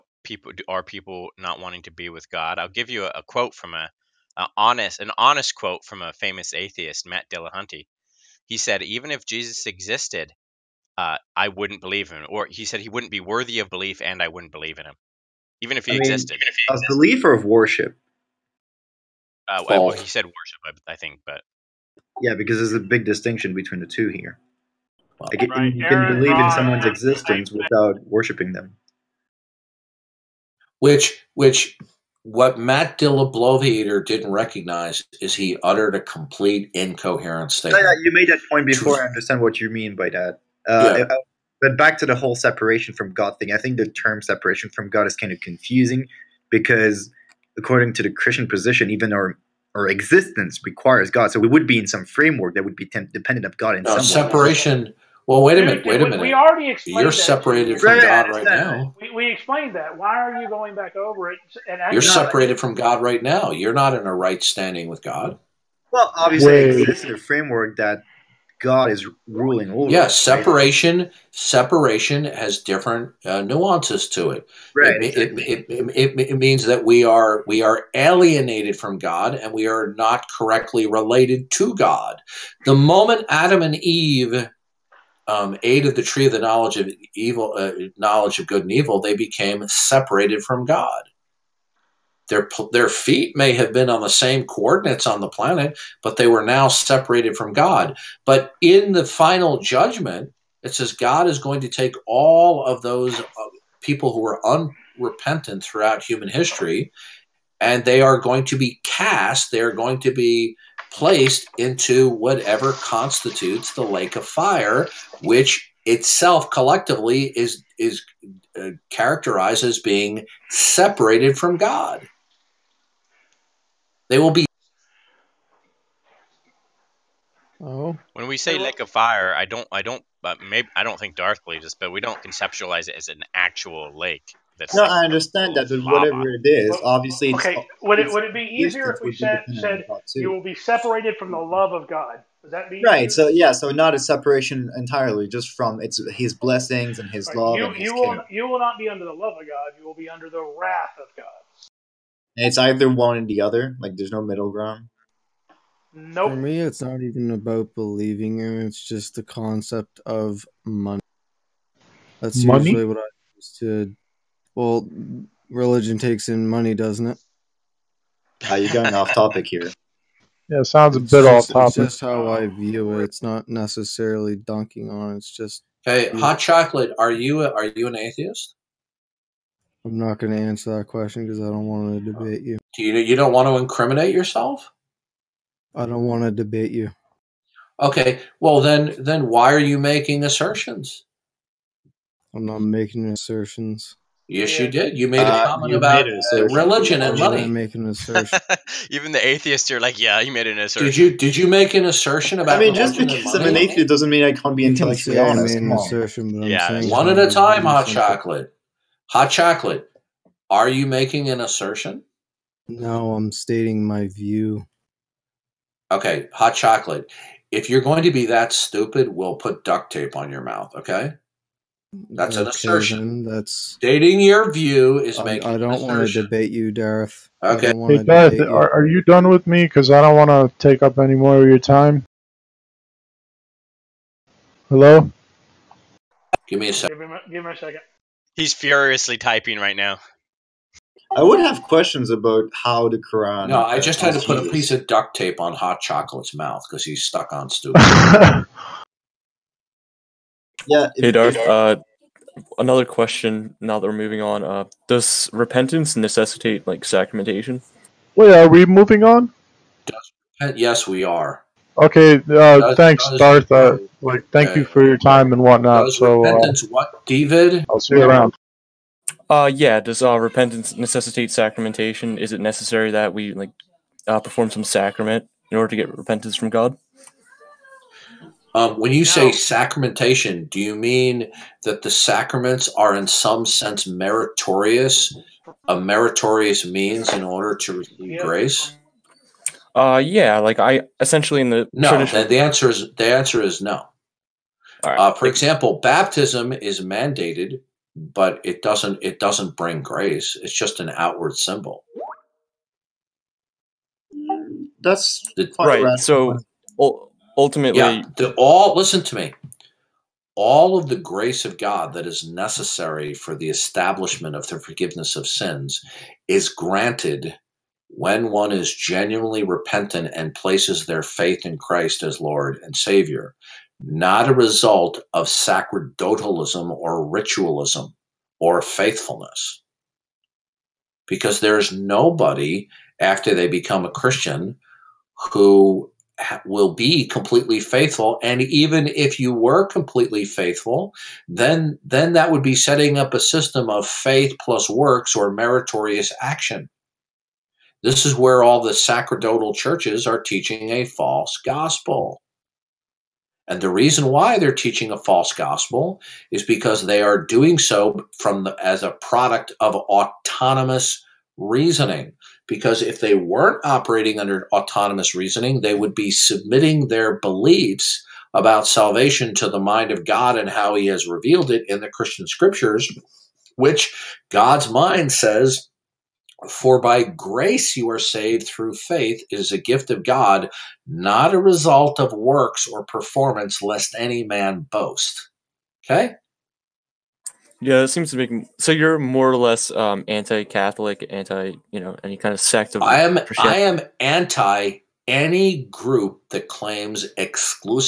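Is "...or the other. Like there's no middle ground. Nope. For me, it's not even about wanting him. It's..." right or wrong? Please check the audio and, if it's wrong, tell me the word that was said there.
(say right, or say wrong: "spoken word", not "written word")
wrong: "believing", not "wanting".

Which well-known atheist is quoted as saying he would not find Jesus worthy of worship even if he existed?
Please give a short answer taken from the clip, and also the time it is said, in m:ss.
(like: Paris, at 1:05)
Matt Dillahunty, at 0:07.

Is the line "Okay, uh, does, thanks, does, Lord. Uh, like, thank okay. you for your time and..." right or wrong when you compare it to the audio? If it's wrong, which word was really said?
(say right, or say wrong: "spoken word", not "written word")
wrong: "Darth", not "Lord".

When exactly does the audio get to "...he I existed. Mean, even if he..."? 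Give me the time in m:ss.
0:15.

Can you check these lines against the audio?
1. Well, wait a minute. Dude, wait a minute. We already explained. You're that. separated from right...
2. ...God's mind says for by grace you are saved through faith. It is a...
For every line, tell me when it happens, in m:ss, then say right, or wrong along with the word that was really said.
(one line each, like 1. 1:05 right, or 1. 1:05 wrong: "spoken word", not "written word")
1. 0:55 right
2. 6:14 right.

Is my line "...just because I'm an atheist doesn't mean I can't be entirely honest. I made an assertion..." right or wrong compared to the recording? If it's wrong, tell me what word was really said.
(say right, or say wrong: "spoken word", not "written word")
wrong: "intellectually", not "entirely".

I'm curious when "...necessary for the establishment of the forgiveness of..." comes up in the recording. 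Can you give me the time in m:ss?
5:12.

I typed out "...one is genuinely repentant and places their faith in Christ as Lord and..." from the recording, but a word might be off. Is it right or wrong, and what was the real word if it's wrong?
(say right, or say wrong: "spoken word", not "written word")
right.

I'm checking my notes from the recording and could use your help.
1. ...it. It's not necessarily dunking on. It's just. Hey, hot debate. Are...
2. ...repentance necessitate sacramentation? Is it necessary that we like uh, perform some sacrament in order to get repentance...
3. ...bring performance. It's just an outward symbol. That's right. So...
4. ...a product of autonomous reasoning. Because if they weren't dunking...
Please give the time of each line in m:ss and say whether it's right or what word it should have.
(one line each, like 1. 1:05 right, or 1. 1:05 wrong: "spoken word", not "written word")
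1. 2:52 wrong: "chocolate", not "debate"
2. 4:30 right
3. 4:59 wrong: "grace", not "performance"
4. 5:58 wrong: "operating", not "dunking".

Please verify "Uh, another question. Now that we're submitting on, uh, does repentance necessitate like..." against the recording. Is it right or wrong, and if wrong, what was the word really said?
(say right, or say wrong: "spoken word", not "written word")
wrong: "moving", not "submitting".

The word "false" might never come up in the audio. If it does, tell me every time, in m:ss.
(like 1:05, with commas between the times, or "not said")
5:50, 5:54.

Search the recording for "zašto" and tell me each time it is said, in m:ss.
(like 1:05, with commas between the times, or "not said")
not said.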